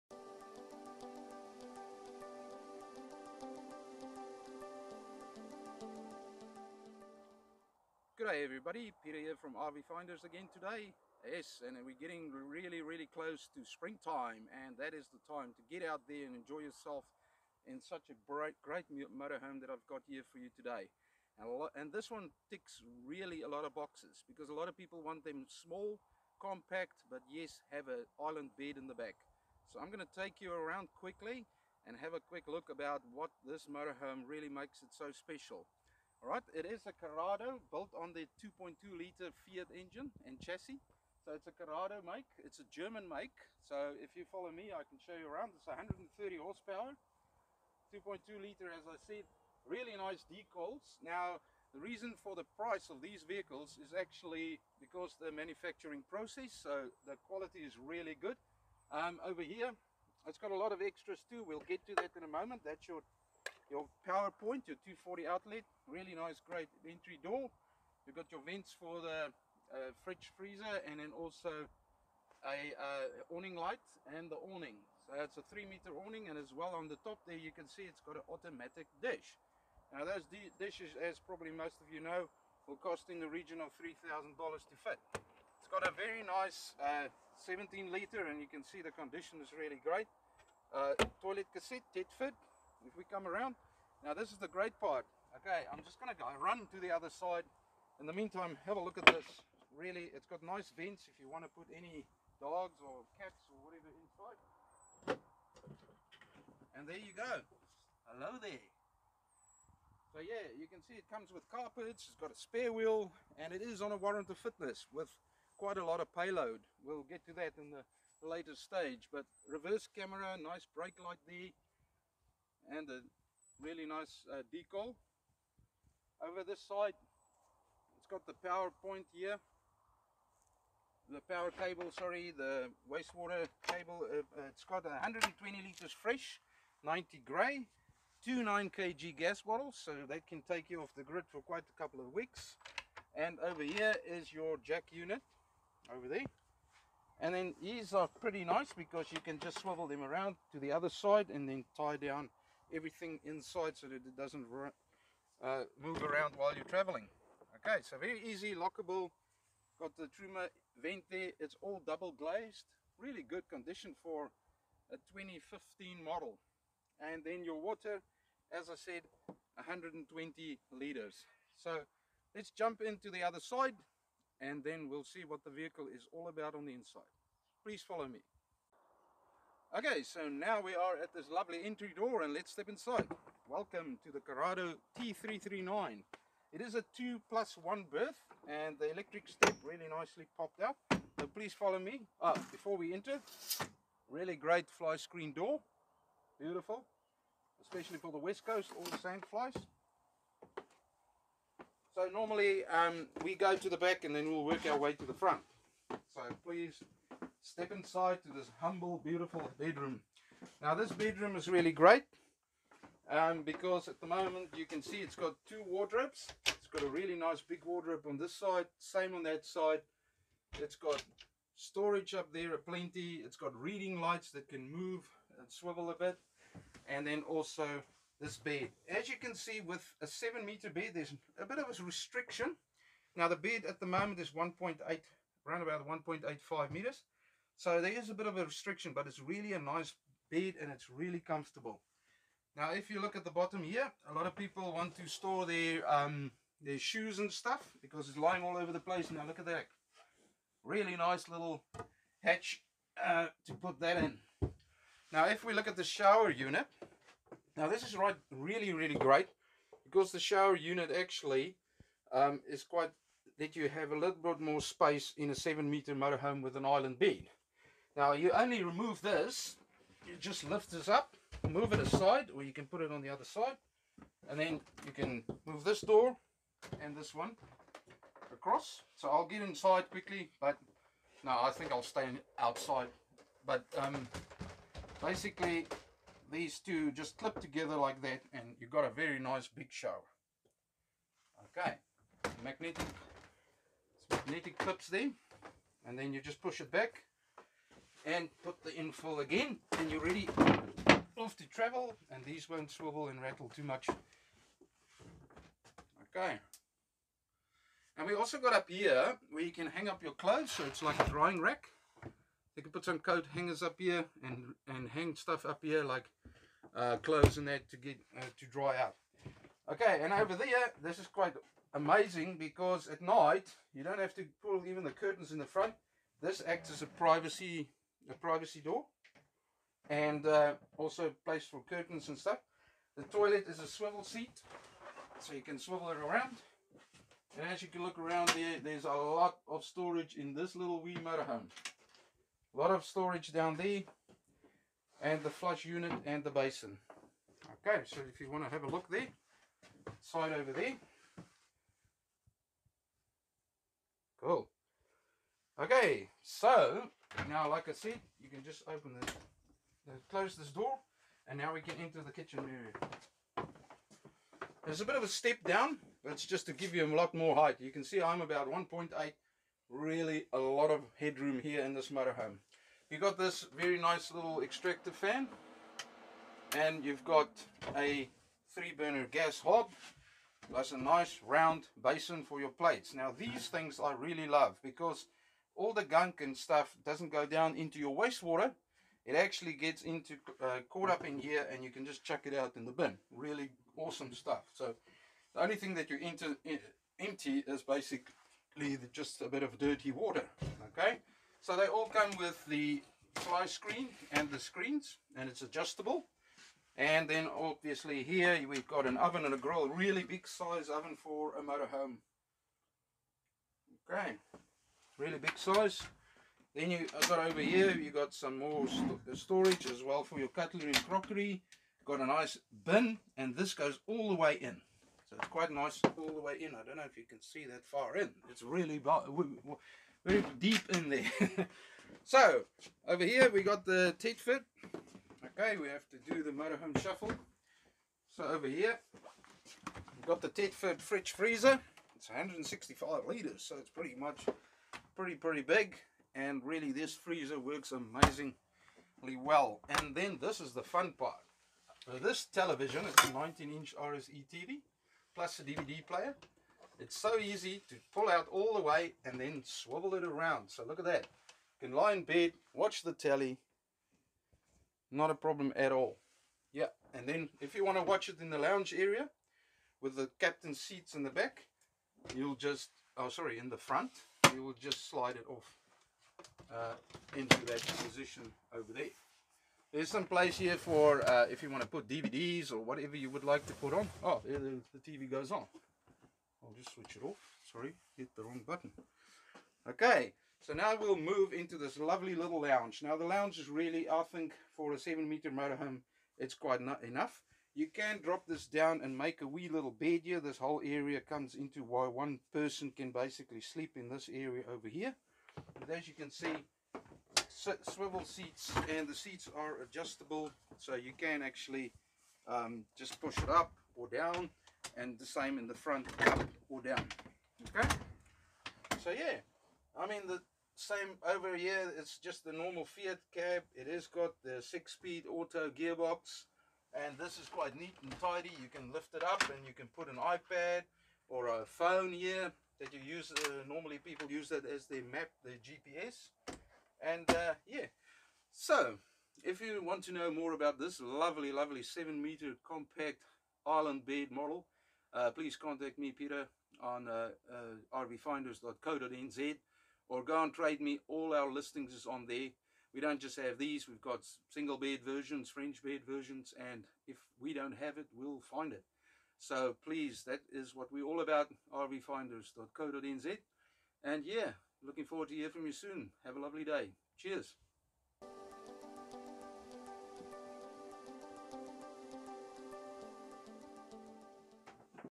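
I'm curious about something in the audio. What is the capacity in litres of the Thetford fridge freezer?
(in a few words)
165 liters.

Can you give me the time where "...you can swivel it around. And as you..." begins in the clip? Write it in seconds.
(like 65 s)
335 s.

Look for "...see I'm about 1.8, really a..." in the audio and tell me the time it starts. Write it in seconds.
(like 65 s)
367 s.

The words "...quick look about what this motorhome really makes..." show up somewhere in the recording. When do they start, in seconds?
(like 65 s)
32 s.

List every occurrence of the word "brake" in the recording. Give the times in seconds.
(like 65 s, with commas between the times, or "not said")
120 s.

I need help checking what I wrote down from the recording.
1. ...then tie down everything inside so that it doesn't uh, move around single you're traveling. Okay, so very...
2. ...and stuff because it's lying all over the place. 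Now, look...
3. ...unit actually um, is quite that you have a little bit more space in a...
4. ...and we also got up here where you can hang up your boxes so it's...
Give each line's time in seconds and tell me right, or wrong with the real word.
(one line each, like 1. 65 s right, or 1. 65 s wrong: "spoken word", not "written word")
1. 151 s wrong: "while", not "single"
2. 247 s right
3. 260 s right
4. 307 s wrong: "clothes", not "boxes".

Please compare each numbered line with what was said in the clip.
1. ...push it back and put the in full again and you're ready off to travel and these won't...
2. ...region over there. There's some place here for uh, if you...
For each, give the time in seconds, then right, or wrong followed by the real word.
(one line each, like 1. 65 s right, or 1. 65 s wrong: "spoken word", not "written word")
1. 296 s right
2. 477 s wrong: "position", not "region".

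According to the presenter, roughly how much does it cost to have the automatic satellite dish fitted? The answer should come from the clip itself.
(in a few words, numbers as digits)
$3,000.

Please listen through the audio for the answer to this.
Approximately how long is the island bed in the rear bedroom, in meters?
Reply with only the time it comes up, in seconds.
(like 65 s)
235 s.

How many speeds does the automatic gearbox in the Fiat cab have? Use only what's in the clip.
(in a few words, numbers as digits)
6.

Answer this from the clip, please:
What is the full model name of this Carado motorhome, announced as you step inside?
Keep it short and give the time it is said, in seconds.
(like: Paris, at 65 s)
Carado T339, at 184 s.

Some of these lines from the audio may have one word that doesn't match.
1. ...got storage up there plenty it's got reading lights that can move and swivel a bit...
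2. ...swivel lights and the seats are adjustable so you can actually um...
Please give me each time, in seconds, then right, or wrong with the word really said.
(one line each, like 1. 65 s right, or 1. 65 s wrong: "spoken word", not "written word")
1. 220 s right
2. 507 s wrong: "seats", not "lights".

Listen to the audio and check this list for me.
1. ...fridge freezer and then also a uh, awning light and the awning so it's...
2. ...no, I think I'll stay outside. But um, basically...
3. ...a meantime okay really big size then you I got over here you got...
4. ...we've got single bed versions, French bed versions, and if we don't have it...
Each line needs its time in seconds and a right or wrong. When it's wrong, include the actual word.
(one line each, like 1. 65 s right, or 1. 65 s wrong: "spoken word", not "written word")
1. 70 s right
2. 281 s right
3. 411 s wrong: "motorhome", not "meantime"
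4. 553 s right.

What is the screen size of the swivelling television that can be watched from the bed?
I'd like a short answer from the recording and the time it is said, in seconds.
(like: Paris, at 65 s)
19 inch, at 453 s.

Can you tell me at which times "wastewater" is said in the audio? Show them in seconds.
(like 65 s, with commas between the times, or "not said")
132 s, 387 s.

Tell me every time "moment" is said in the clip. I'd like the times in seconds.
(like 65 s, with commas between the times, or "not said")
62 s, 214 s, 233 s.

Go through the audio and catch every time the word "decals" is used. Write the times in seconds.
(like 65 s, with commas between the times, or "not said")
50 s, 124 s.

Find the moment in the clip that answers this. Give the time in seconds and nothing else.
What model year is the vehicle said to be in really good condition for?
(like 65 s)
165 s.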